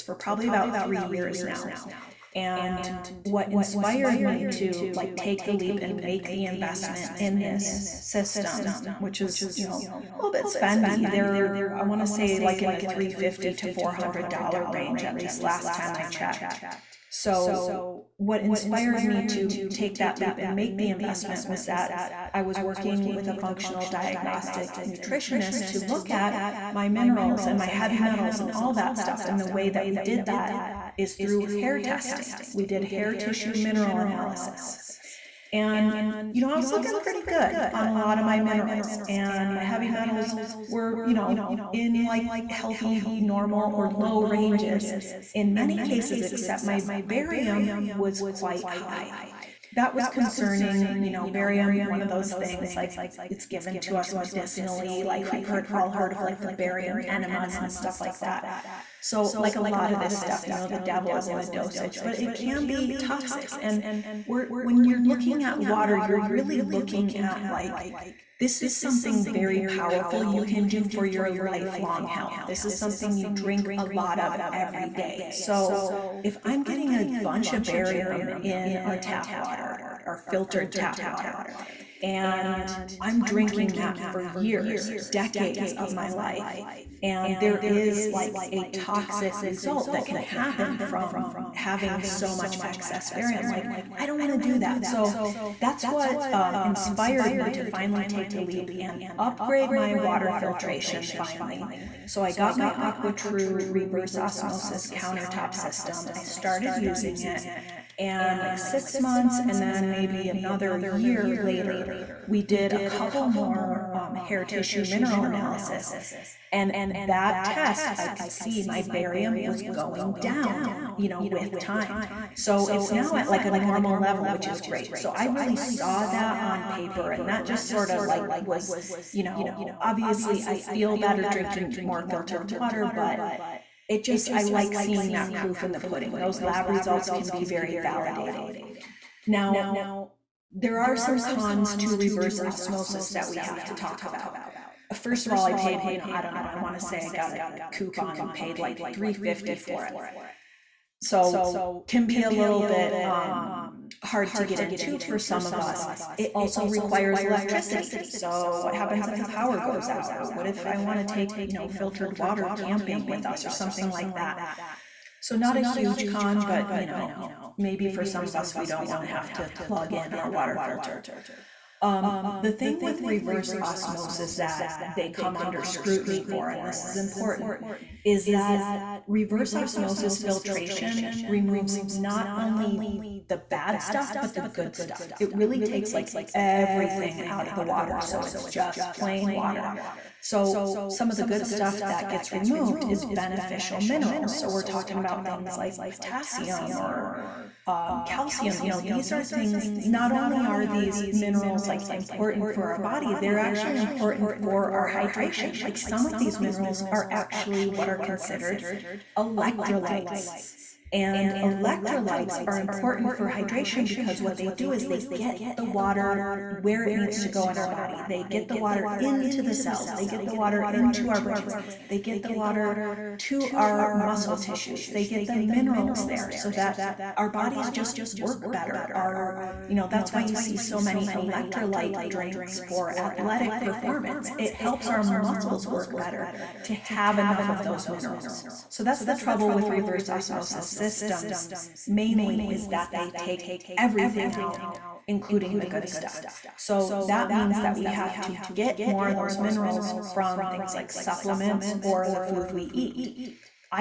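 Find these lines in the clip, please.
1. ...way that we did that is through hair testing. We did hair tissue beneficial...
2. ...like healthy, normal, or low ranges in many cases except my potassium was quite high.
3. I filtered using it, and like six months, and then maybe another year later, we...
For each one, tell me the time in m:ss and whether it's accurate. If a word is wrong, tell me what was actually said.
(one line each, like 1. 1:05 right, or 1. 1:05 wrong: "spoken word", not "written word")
1. 0:29 wrong: "mineral", not "beneficial"
2. 0:42 wrong: "barium", not "potassium"
3. 1:46 wrong: "started", not "filtered".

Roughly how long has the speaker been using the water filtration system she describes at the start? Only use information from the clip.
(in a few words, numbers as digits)
about three years.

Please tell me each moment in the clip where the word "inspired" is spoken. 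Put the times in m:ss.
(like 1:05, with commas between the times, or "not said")
0:03, 0:18, 1:36.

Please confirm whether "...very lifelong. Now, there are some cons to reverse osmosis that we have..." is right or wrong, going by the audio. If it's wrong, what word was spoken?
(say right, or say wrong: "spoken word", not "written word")
wrong: "validating", not "lifelong".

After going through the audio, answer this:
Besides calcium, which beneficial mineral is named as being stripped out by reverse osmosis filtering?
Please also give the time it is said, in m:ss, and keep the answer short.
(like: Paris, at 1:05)
potassium, at 3:15.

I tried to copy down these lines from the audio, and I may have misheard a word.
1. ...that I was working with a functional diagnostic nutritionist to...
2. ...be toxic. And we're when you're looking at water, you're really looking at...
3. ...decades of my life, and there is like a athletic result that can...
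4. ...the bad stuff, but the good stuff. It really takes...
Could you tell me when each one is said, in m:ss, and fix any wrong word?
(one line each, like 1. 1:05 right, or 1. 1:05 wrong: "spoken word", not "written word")
1. 0:21 right
2. 1:02 right
3. 1:25 wrong: "toxic", not "athletic"
4. 3:03 right.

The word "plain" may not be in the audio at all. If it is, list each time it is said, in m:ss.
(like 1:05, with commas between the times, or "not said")
3:08.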